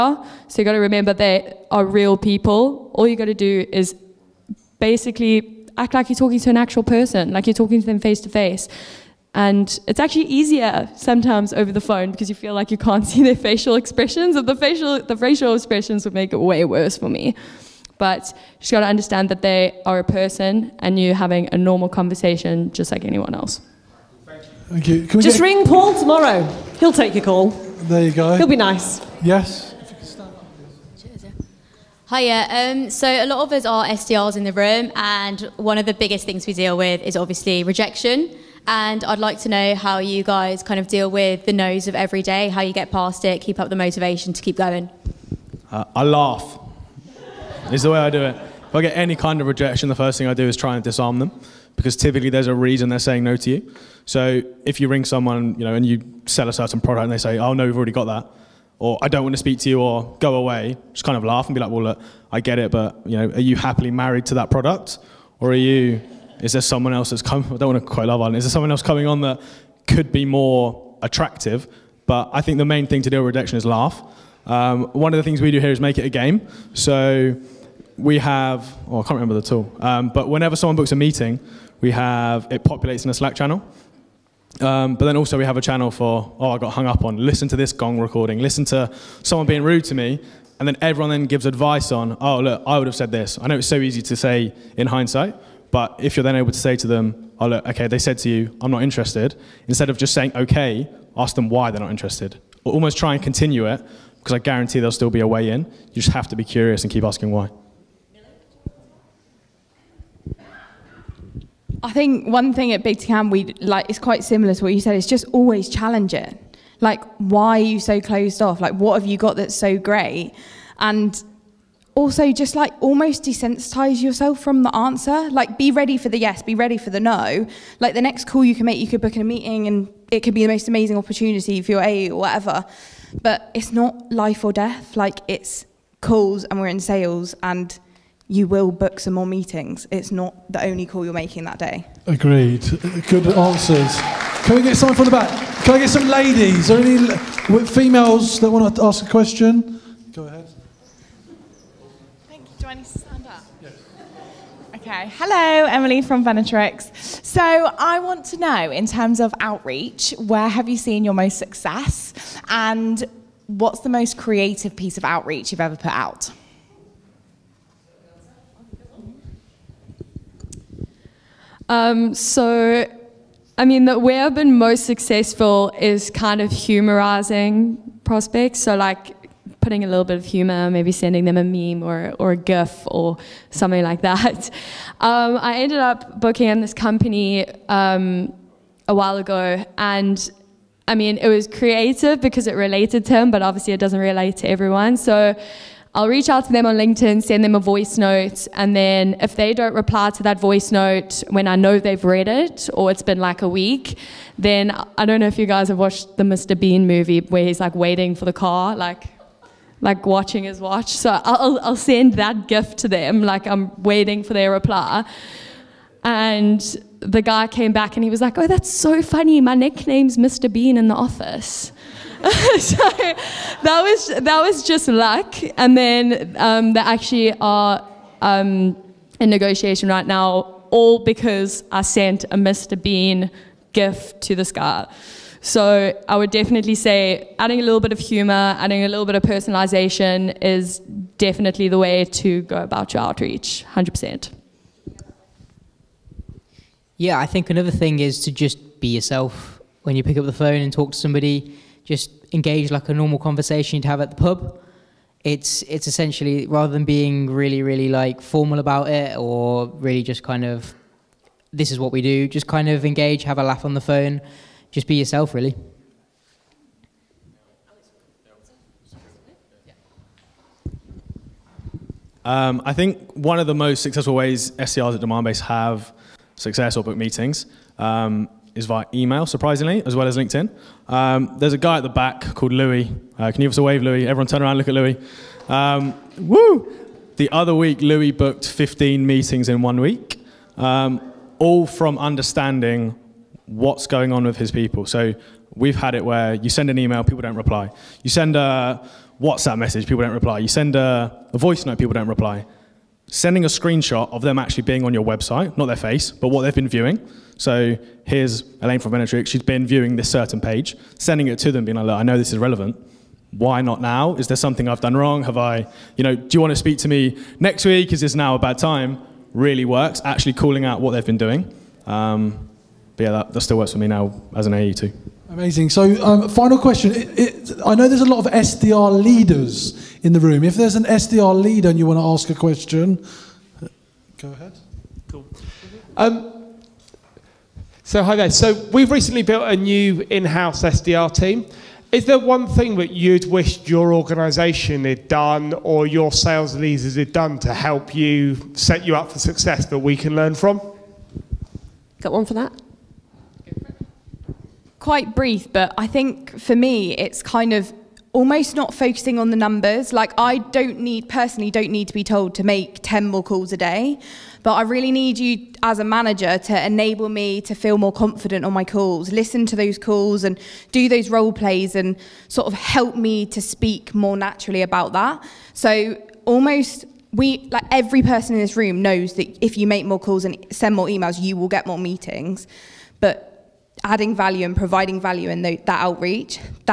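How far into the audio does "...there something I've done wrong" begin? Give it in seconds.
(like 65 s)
314 s.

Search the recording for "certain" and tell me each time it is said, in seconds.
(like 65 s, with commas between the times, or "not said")
56 s, 310 s.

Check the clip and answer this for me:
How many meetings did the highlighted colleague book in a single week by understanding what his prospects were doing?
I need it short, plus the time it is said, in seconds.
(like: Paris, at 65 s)
15, at 288 s.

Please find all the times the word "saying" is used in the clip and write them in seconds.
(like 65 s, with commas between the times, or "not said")
52 s, 100 s.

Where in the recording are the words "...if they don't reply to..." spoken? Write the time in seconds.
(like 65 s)
199 s.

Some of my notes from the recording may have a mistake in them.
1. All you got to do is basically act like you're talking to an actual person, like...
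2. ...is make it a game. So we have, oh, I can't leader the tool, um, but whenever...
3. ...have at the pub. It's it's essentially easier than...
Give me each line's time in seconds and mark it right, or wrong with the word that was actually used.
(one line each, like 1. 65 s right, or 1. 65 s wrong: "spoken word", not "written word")
1. 2 s right
2. 75 s wrong: "remember", not "leader"
3. 253 s wrong: "rather", not "easier".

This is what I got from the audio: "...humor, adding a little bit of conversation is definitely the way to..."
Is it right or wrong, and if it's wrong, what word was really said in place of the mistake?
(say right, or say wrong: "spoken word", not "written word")
wrong: "personalization", not "conversation".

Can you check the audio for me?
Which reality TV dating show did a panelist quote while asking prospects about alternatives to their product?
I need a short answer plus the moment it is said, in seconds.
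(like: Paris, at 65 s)
Love Island, at 68 s.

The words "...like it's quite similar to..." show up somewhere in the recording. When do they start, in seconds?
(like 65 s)
113 s.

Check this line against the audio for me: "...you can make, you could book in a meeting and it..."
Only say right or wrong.
right.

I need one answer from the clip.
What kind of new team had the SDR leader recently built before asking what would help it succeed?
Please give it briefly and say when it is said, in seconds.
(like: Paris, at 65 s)
in house SDR team, at 340 s.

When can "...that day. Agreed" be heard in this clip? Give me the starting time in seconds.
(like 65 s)
141 s.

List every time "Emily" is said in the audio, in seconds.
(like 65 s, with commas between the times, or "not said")
155 s.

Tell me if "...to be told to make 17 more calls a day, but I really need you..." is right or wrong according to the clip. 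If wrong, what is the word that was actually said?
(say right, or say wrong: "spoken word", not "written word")
wrong: "10", not "17".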